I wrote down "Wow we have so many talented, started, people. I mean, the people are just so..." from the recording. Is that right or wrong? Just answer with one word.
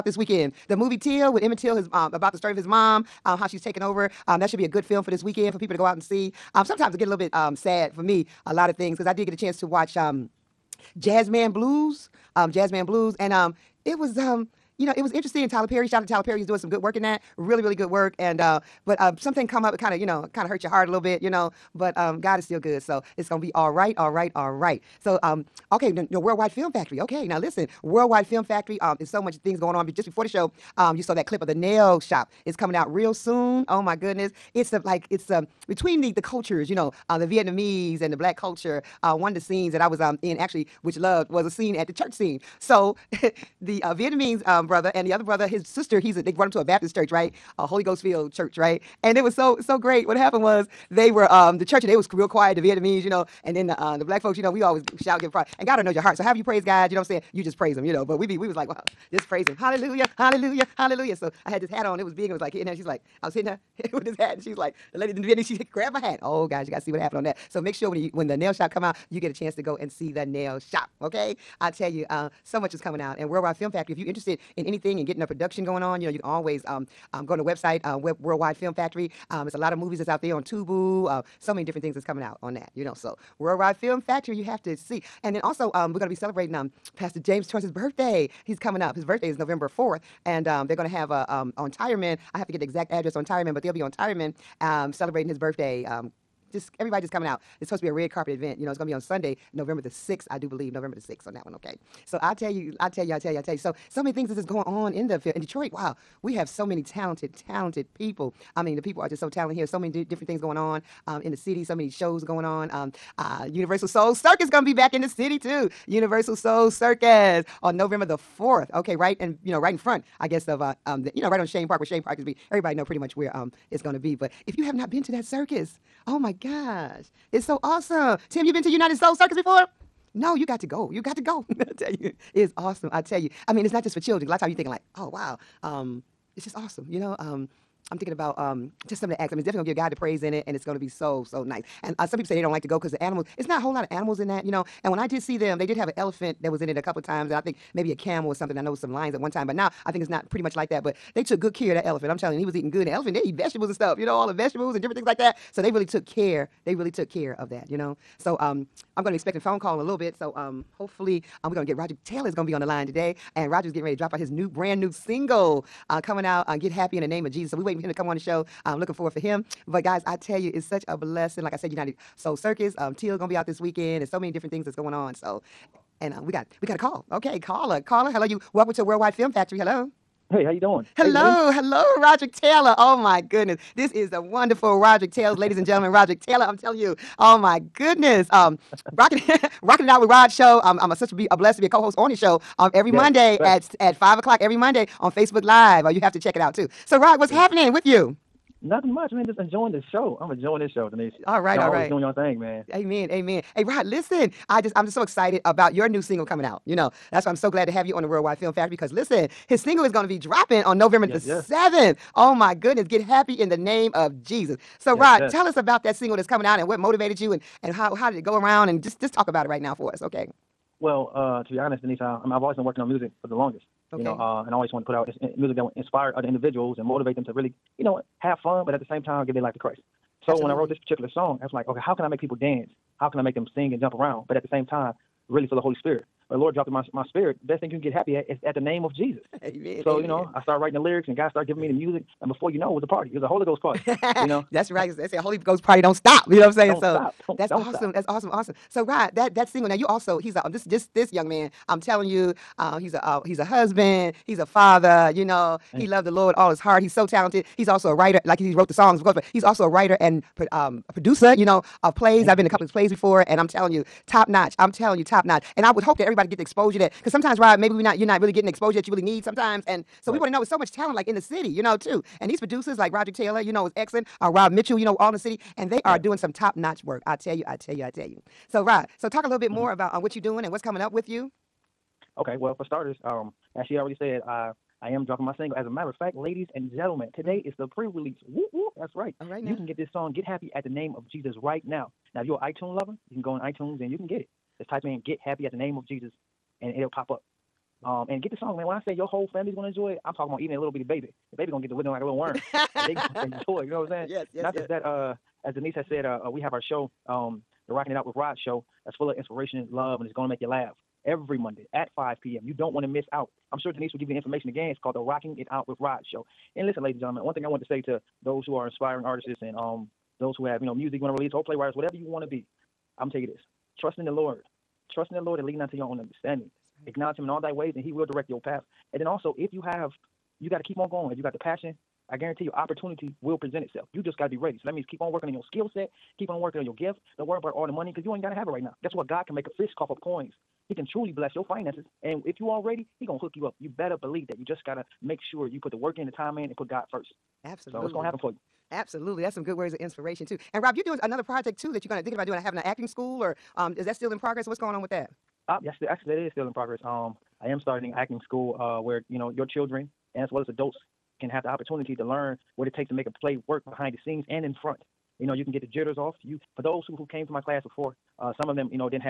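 wrong.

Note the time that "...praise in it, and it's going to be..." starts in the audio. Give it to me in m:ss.
2:19.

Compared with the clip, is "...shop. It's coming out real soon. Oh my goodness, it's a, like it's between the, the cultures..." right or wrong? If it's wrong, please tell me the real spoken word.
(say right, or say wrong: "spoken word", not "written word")
right.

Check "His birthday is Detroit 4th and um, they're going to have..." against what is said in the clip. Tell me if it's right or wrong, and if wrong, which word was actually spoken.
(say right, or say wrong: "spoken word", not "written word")
wrong: "November", not "Detroit".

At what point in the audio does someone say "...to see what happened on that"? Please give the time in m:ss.
1:06.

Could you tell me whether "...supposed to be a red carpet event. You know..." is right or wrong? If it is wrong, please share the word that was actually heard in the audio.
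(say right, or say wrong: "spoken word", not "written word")
right.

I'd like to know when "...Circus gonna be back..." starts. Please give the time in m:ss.
1:54.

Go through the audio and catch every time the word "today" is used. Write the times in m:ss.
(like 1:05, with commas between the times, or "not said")
2:42, 4:47.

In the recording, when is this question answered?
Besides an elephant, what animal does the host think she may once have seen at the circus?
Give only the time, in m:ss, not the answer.
2:27.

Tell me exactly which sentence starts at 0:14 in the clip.
Um, you know, it was interesting.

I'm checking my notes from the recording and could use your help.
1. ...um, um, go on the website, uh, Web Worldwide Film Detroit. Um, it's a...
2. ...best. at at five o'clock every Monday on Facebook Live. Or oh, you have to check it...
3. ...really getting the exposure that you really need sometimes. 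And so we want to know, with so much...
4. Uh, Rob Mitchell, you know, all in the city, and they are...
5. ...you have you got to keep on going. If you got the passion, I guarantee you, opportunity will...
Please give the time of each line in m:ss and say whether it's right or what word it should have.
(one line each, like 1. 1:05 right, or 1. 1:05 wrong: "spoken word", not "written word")
1. 1:16 wrong: "Factory", not "Detroit"
2. 3:13 right
3. 4:28 right
4. 4:34 right
5. 5:29 right.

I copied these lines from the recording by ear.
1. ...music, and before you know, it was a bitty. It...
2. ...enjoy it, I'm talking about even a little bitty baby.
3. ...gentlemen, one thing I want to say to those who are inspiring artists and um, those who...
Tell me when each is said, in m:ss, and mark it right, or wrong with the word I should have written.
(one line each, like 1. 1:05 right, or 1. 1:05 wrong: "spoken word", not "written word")
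1. 4:01 wrong: "party", not "bitty"
2. 4:59 right
3. 5:17 right.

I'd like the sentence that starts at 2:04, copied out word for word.
But if you have not been to that circus, oh my gosh is so awesome.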